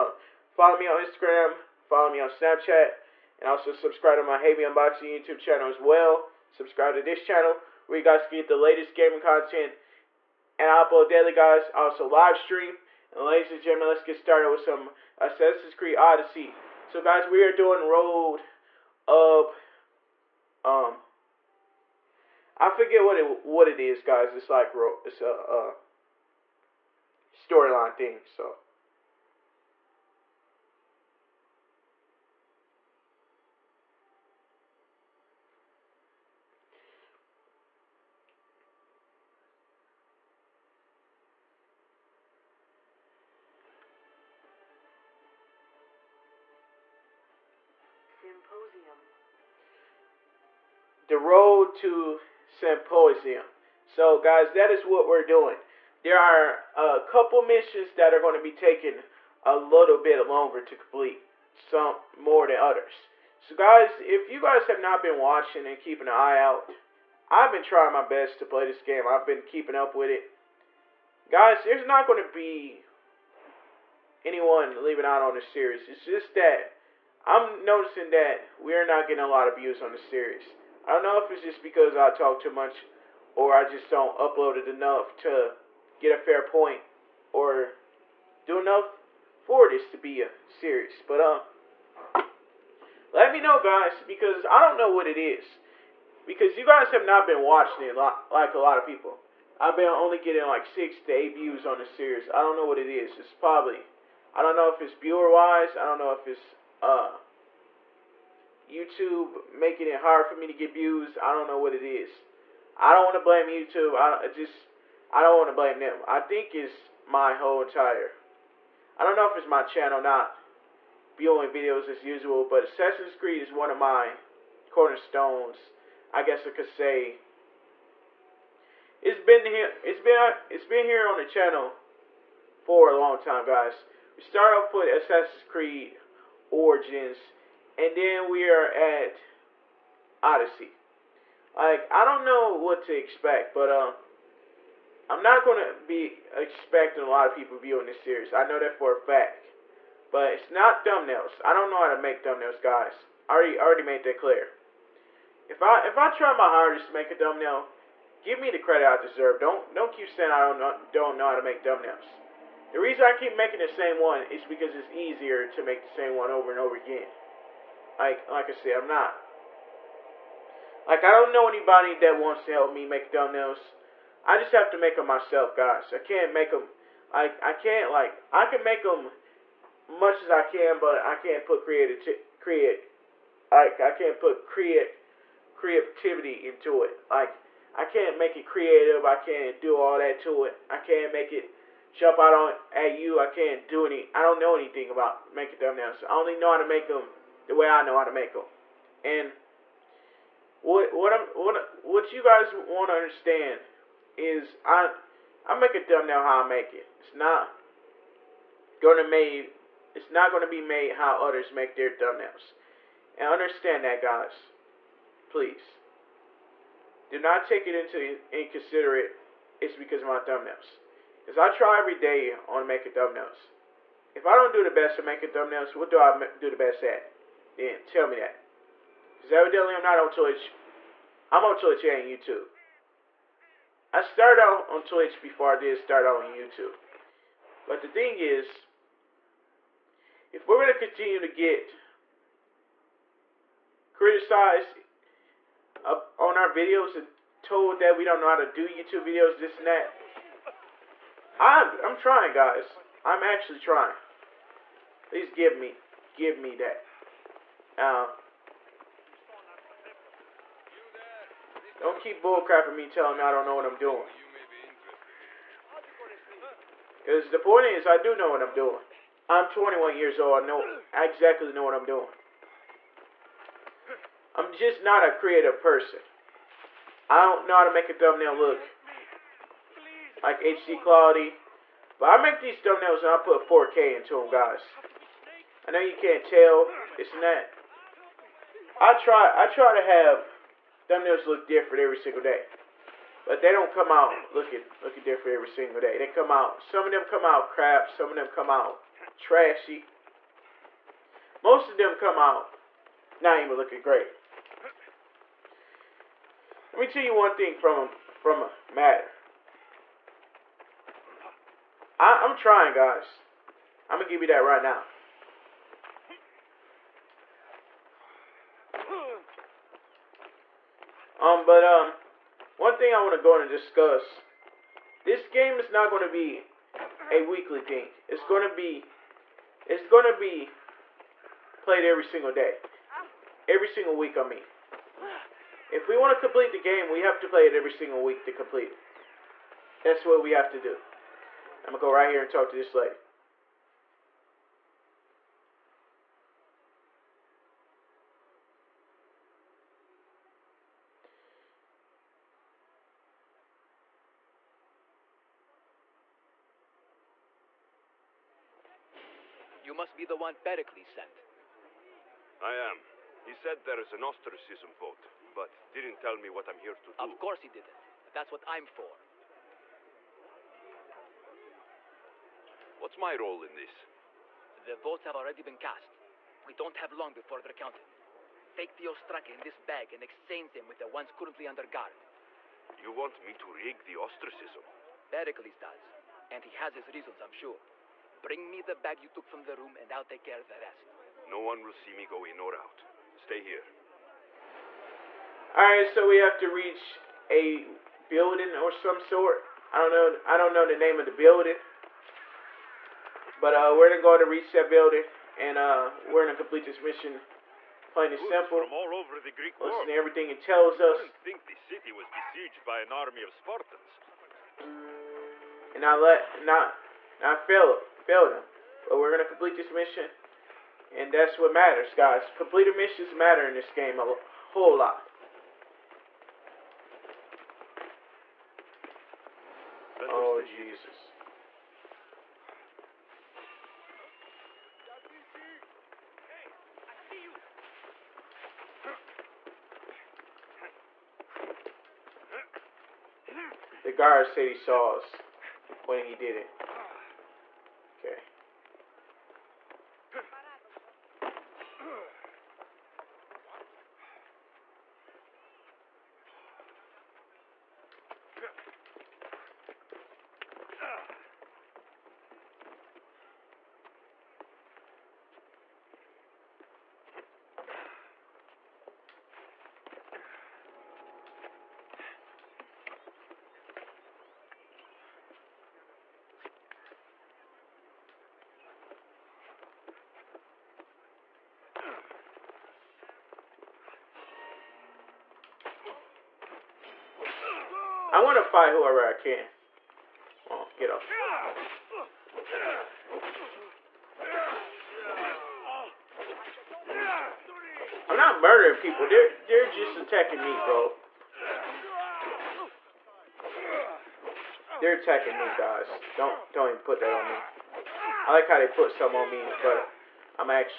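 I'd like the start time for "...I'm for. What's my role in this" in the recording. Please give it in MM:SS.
06:08.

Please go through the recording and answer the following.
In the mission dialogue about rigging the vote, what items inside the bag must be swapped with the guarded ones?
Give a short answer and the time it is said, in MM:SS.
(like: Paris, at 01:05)
Ostraca, at 06:18.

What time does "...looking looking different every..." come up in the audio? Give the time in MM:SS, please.
04:54.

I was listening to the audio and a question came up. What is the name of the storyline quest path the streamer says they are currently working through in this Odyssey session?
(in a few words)
The Road to Symposium.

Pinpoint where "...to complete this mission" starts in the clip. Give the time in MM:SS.
06:59.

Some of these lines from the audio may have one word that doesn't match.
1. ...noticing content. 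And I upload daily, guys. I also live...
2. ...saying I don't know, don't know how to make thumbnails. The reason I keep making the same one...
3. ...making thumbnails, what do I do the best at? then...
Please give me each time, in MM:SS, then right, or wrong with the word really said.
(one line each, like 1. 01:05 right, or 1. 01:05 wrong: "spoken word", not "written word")
1. 00:08 wrong: "gaming", not "noticing"
2. 02:40 right
3. 03:45 right.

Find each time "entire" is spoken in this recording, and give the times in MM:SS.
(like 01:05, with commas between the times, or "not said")
01:57.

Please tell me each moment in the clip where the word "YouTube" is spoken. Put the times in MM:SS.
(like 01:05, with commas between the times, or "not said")
00:05, 01:48, 01:53, 03:52, 03:56, 04:08.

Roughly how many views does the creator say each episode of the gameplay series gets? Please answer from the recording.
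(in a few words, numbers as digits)
6 to 8.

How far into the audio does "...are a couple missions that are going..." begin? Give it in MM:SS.
00:56.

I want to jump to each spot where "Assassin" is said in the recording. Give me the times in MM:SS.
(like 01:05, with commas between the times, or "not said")
00:15, 02:02, 02:14.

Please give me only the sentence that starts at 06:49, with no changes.
Listen to everything it tells us.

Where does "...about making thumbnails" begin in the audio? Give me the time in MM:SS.
03:14.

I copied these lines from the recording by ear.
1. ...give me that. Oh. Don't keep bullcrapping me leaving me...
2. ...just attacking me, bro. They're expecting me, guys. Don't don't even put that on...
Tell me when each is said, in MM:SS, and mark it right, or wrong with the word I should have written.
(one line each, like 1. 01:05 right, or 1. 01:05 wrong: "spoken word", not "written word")
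1. 04:16 wrong: "telling", not "leaving"
2. 08:19 wrong: "attacking", not "expecting".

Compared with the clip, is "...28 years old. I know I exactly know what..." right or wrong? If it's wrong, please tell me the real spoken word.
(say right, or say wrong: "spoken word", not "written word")
wrong: "21", not "28".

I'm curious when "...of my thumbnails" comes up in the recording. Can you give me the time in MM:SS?
03:40.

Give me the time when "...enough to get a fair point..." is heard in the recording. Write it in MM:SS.
01:24.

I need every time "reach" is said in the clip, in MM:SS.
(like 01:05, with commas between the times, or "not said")
06:36, 06:44.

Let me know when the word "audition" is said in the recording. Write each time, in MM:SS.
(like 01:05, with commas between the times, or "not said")
not said.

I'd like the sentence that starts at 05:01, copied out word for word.
Most of them come out not even looking great.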